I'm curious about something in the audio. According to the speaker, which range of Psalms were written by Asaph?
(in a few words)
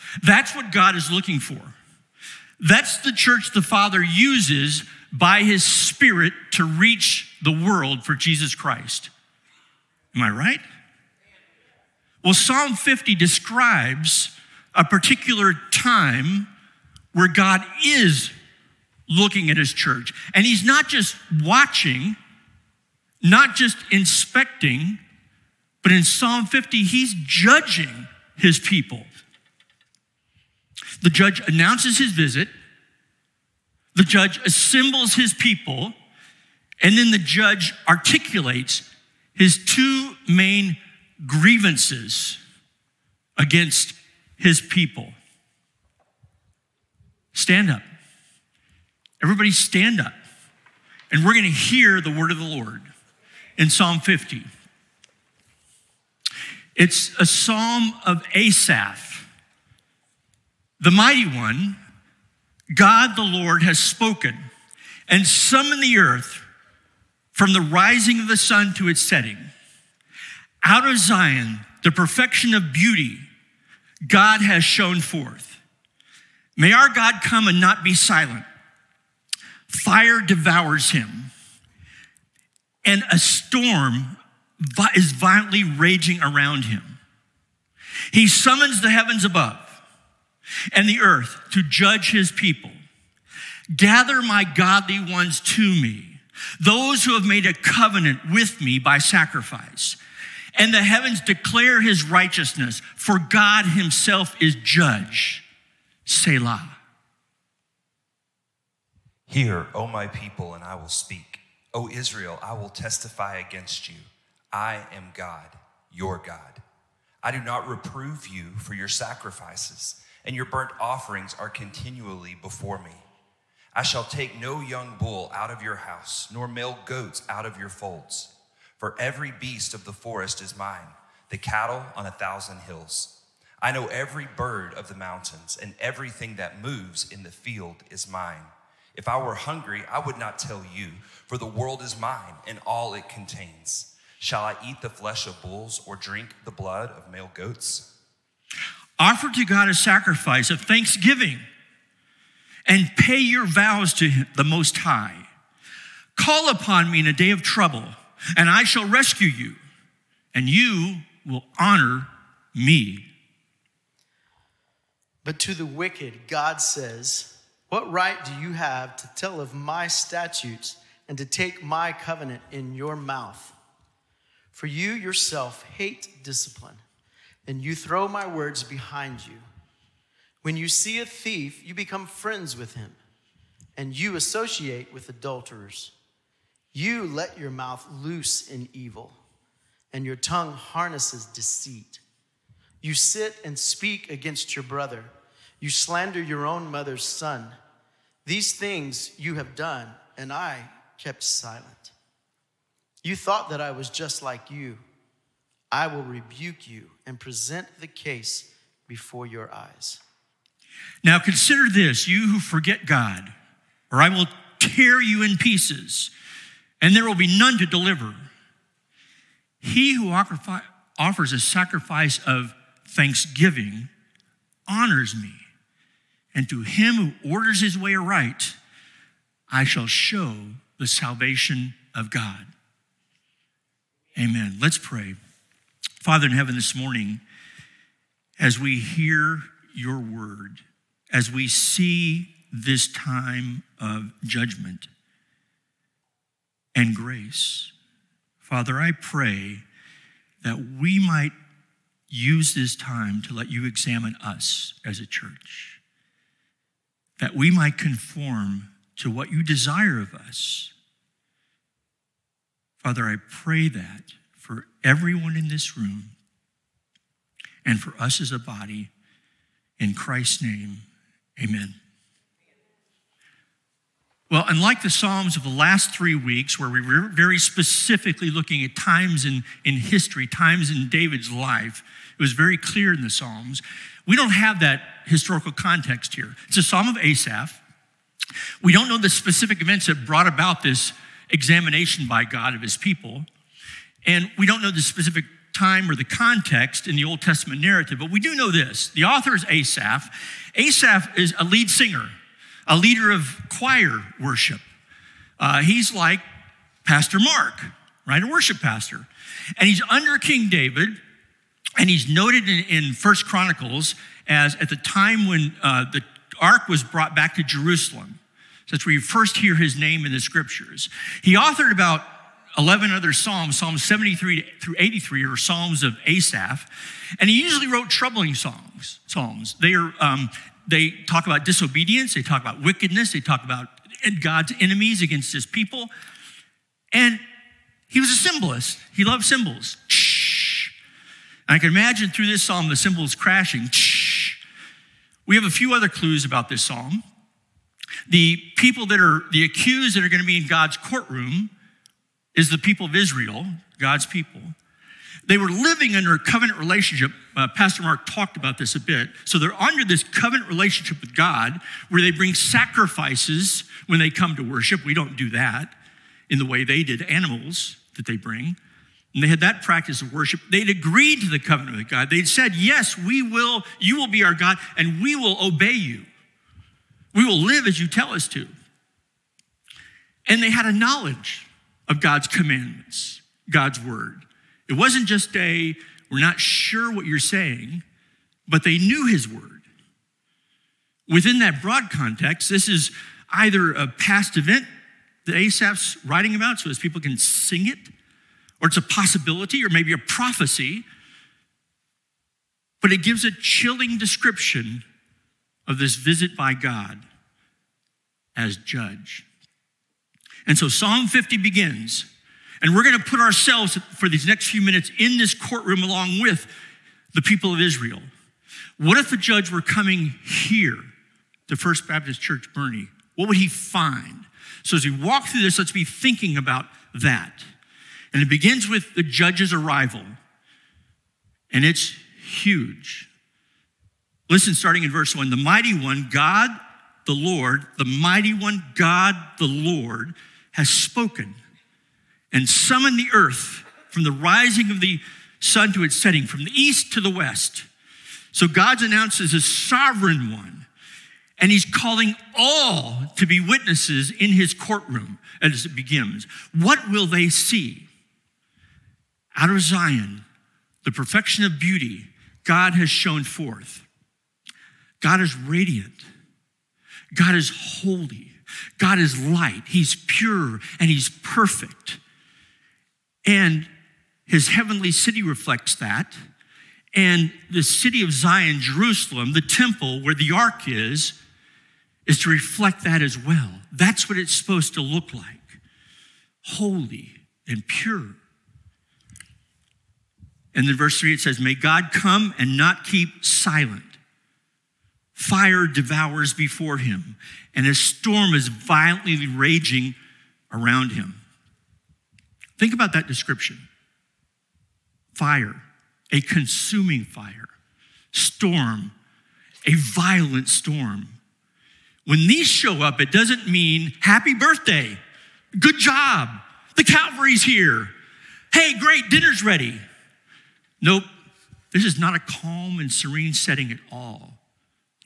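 73 through 83.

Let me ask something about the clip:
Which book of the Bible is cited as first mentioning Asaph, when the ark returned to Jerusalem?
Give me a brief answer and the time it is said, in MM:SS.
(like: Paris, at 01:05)
First Chronicles, at 05:12.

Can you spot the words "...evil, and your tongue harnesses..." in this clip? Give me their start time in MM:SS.
03:08.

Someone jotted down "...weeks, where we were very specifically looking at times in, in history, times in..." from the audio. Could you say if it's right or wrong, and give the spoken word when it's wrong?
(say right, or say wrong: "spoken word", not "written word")
right.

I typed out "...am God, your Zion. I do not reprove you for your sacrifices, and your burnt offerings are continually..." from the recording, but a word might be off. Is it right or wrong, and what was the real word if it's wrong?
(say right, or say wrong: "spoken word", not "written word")
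wrong: "God", not "Zion".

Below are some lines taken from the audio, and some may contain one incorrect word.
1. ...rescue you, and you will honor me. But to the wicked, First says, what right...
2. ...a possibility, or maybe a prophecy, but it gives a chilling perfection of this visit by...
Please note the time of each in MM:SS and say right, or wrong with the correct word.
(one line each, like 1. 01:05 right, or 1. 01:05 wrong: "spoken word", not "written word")
1. 02:38 wrong: "God", not "First"
2. 06:38 wrong: "description", not "perfection".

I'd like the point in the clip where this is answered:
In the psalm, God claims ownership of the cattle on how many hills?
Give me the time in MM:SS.
02:12.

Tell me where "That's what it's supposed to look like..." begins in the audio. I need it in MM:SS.
08:03.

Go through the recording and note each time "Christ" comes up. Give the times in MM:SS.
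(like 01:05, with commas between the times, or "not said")
00:08, 04:29.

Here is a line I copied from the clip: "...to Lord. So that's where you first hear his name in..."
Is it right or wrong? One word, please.
wrong.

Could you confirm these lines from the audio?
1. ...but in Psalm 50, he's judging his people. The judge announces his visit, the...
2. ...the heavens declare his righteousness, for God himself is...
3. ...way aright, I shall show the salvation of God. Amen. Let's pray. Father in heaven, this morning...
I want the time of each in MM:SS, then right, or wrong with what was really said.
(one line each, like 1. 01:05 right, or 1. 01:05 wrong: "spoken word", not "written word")
1. 00:25 right
2. 01:40 right
3. 03:47 right.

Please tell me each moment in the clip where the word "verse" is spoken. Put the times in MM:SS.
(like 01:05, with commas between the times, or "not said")
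07:14, 08:10.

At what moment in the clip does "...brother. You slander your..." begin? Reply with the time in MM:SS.
03:14.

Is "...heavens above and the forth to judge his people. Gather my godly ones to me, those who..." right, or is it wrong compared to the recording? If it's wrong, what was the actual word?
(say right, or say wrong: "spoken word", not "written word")
wrong: "earth", not "forth".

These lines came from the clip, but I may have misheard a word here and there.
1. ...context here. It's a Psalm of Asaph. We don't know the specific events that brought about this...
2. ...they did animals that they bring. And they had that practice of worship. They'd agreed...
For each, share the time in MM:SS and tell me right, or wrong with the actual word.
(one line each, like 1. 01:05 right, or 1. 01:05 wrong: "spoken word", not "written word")
1. 04:45 right
2. 06:06 right.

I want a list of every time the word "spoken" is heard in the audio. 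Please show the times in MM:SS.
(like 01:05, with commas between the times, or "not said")
01:03, 07:20.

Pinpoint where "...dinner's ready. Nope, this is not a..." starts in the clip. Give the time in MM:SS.
08:39.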